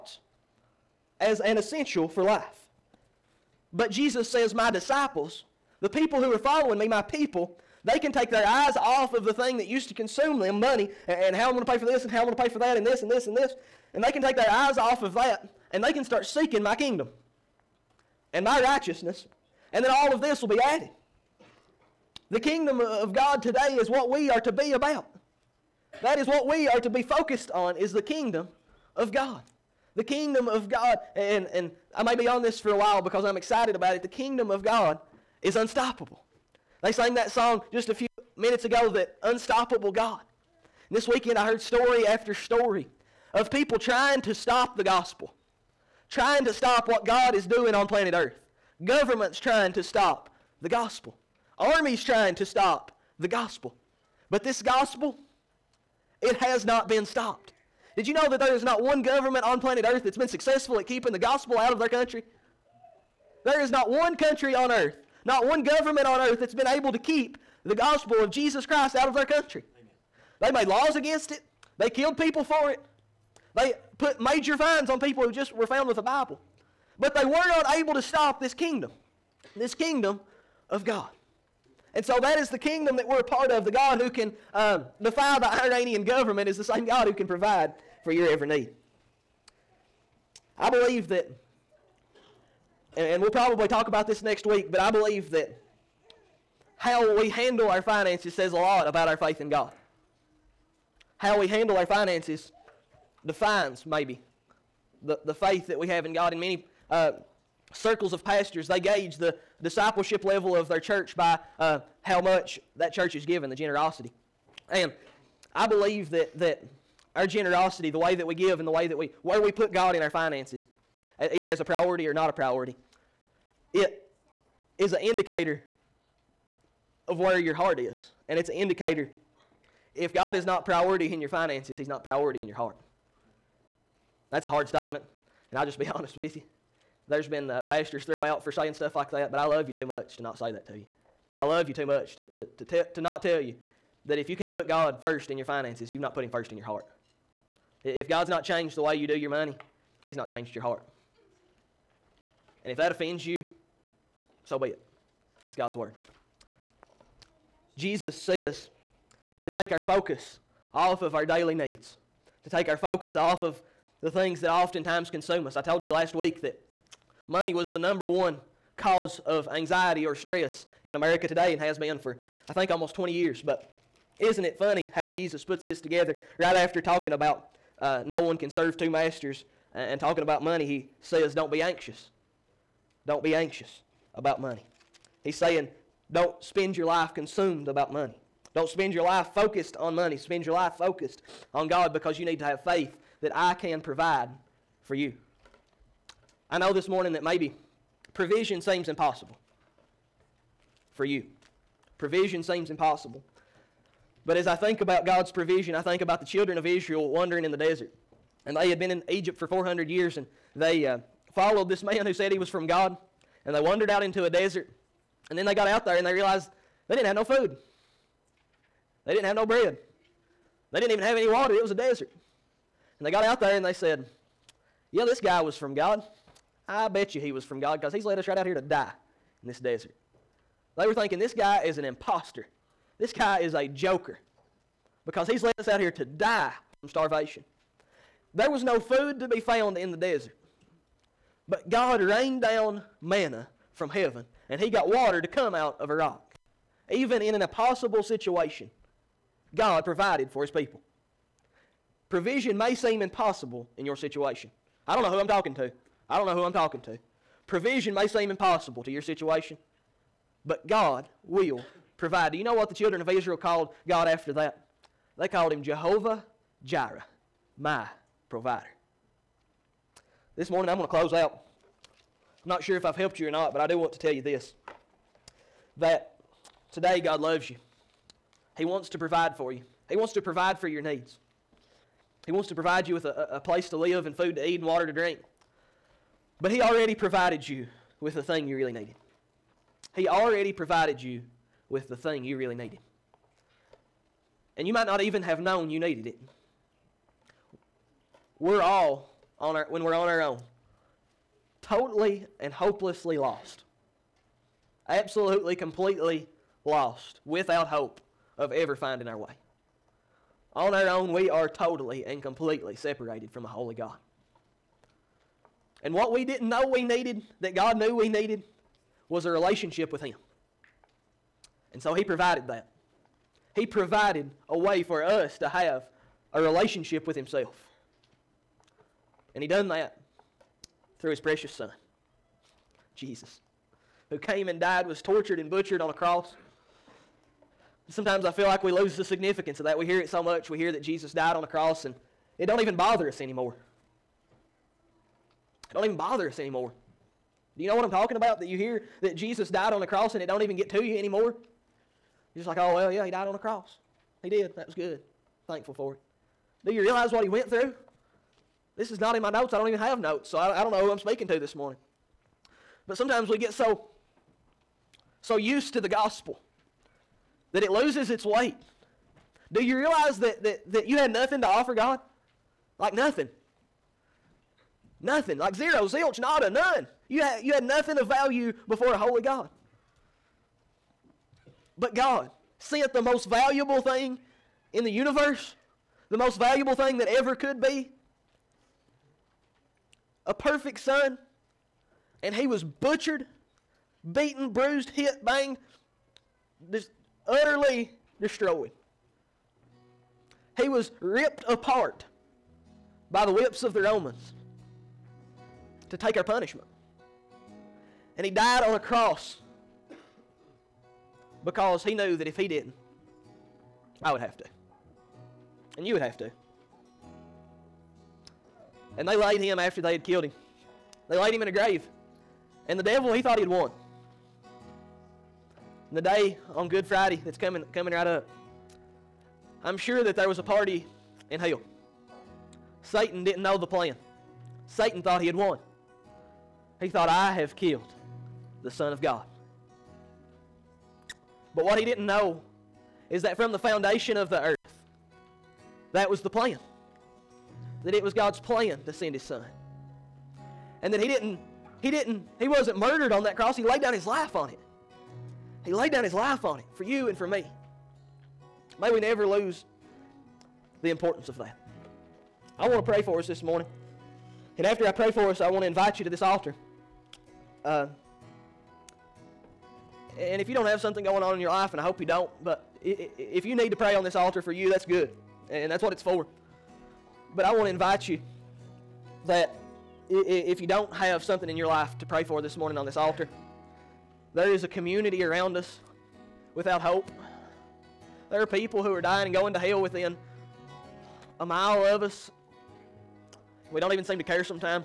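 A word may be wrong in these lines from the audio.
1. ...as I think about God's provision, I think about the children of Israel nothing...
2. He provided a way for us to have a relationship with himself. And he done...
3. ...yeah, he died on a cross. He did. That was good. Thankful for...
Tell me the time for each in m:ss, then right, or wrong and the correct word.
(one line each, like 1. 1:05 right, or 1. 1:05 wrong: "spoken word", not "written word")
1. 3:24 wrong: "wandering", not "nothing"
2. 5:23 right
3. 5:52 right.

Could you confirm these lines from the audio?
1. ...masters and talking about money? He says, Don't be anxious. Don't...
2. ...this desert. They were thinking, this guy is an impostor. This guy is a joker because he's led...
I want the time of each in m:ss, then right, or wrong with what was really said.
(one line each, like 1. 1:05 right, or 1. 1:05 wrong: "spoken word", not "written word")
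1. 2:58 right
2. 3:49 right.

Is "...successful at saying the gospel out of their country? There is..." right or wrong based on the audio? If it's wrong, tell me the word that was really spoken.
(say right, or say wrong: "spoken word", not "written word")
wrong: "keeping", not "saying".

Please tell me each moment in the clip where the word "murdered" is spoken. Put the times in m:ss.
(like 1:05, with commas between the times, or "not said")
7:32.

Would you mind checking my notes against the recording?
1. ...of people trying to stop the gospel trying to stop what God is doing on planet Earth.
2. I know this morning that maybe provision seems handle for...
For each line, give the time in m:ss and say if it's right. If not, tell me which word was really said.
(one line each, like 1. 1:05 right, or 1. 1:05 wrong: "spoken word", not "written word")
1. 0:43 right
2. 3:16 wrong: "impossible", not "handle".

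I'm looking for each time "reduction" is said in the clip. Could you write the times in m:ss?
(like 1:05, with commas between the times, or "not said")
not said.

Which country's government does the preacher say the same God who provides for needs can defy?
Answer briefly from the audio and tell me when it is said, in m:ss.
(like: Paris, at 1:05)
Iranian, at 1:25.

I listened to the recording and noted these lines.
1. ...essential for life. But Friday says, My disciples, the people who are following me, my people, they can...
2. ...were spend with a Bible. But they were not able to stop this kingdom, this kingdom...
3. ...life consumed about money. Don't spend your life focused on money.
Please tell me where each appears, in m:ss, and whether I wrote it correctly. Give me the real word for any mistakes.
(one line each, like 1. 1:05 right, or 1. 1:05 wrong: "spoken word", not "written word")
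1. 0:01 wrong: "Jesus", not "Friday"
2. 1:15 wrong: "found", not "spend"
3. 3:06 right.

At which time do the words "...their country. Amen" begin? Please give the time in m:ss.
1:09.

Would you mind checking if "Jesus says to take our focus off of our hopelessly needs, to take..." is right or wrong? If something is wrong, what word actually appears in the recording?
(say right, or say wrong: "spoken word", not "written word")
wrong: "daily", not "hopelessly".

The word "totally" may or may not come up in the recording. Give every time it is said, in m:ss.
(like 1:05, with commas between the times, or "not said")
5:01, 5:11.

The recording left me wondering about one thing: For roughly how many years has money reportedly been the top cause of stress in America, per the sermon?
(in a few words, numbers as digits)
20.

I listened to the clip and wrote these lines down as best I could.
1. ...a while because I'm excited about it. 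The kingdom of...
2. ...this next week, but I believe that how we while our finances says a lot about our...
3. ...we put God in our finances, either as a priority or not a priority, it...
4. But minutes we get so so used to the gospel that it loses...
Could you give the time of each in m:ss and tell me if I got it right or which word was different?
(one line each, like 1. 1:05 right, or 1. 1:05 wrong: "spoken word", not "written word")
1. 0:32 right
2. 1:34 wrong: "handle", not "while"
3. 1:59 right
4. 6:02 wrong: "sometimes", not "minutes".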